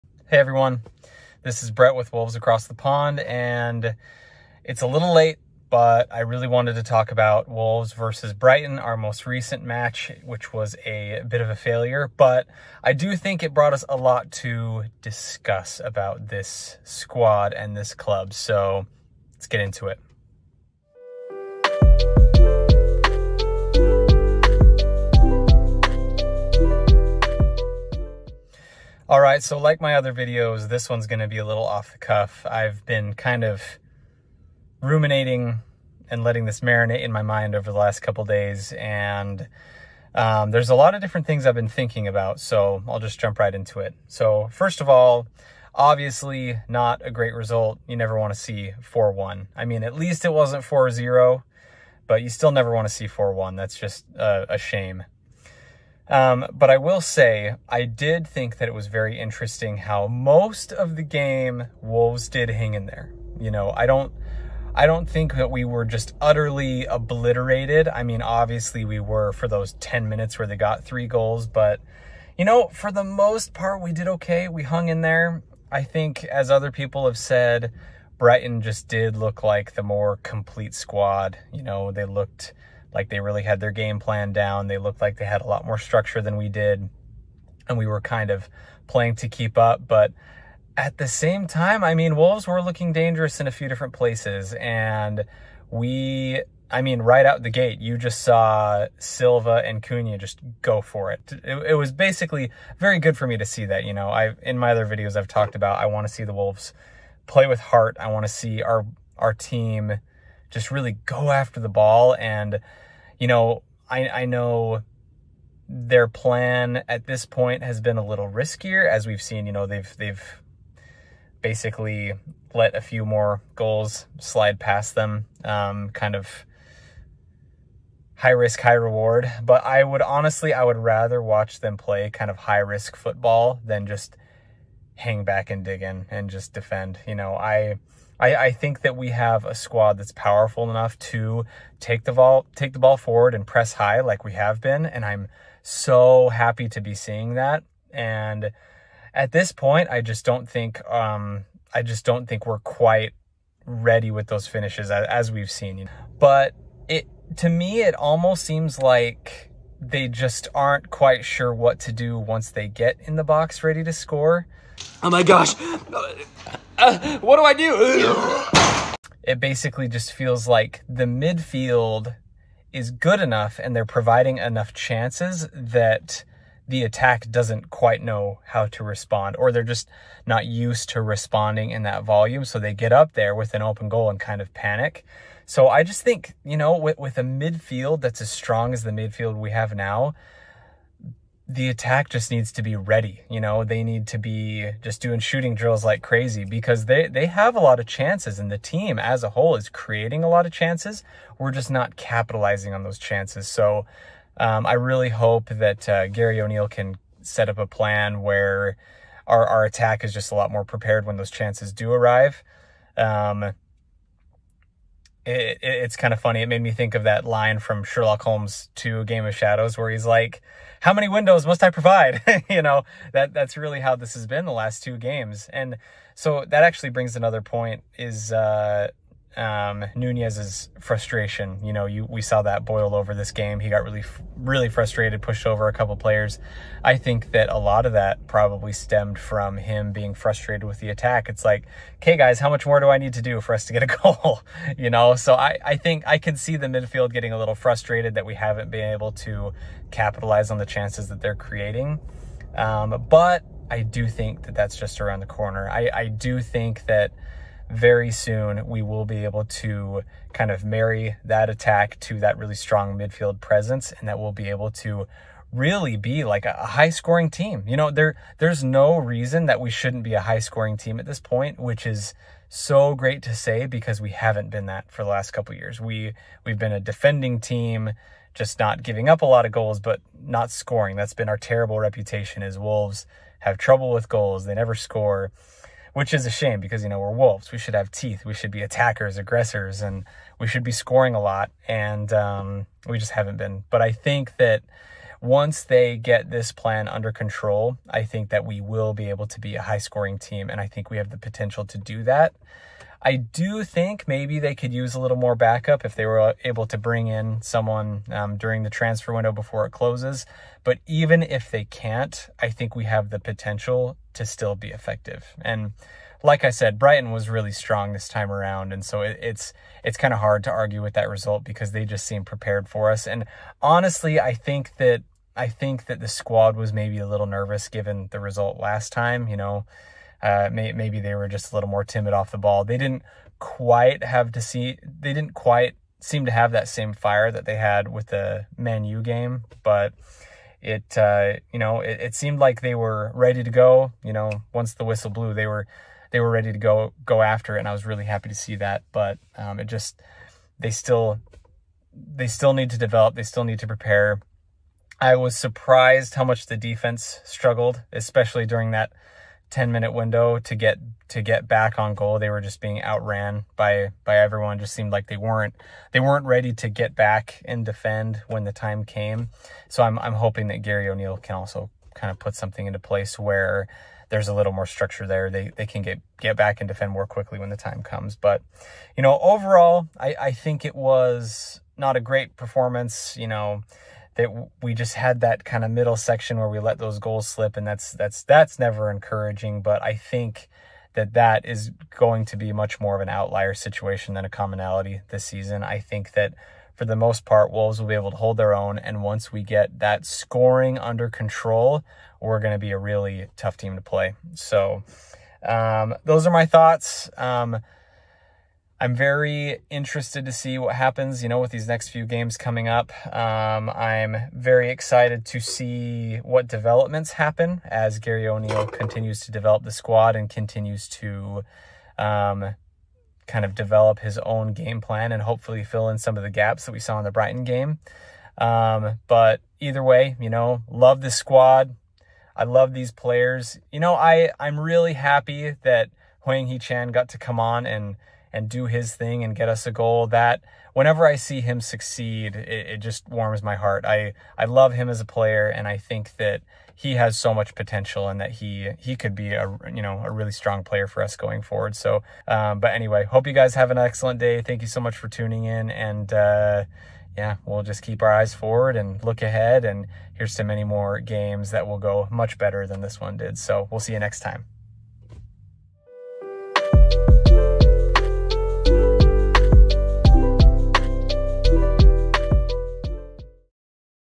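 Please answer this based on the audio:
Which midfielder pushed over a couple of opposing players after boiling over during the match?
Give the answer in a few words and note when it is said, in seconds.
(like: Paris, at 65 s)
Nunes, at 229 s.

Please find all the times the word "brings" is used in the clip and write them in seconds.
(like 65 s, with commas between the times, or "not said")
226 s, 306 s.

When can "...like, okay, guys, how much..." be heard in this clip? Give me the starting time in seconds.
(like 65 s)
241 s.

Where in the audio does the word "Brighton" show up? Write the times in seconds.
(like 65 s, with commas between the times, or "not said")
8 s, 78 s, 316 s, 427 s.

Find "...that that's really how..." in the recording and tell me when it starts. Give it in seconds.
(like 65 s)
223 s.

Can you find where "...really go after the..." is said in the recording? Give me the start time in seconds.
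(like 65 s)
110 s.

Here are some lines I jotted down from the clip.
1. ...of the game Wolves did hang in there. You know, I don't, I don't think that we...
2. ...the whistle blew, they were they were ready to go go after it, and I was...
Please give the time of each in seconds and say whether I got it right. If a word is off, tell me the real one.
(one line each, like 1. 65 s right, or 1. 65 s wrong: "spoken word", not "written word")
1. 60 s right
2. 344 s right.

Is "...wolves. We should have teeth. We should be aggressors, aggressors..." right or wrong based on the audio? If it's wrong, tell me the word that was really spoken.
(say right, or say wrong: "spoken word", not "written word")
wrong: "attackers", not "aggressors".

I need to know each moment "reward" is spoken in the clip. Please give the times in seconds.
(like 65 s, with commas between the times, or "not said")
128 s.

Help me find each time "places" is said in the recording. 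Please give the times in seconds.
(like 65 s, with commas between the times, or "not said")
93 s, 372 s.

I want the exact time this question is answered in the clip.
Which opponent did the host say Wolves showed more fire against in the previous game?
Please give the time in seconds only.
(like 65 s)
338 s.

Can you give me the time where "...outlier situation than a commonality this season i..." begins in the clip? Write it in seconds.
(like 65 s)
393 s.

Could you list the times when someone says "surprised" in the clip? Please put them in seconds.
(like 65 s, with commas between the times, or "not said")
355 s.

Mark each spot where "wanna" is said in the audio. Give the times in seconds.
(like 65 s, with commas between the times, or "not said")
48 s, 52 s.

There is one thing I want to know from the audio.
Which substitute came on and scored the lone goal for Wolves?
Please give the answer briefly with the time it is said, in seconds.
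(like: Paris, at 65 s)
Hwang Hee Chan, at 436 s.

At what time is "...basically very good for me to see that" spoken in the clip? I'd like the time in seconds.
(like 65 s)
101 s.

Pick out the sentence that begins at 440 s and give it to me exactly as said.
That whenever I see him succeed, it, it just warms my heart.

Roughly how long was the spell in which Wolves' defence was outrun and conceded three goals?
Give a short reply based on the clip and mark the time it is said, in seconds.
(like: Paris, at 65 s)
10 minutes, at 69 s.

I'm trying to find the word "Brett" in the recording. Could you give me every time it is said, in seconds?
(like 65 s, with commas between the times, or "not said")
1 s.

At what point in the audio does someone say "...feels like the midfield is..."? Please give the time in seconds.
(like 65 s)
170 s.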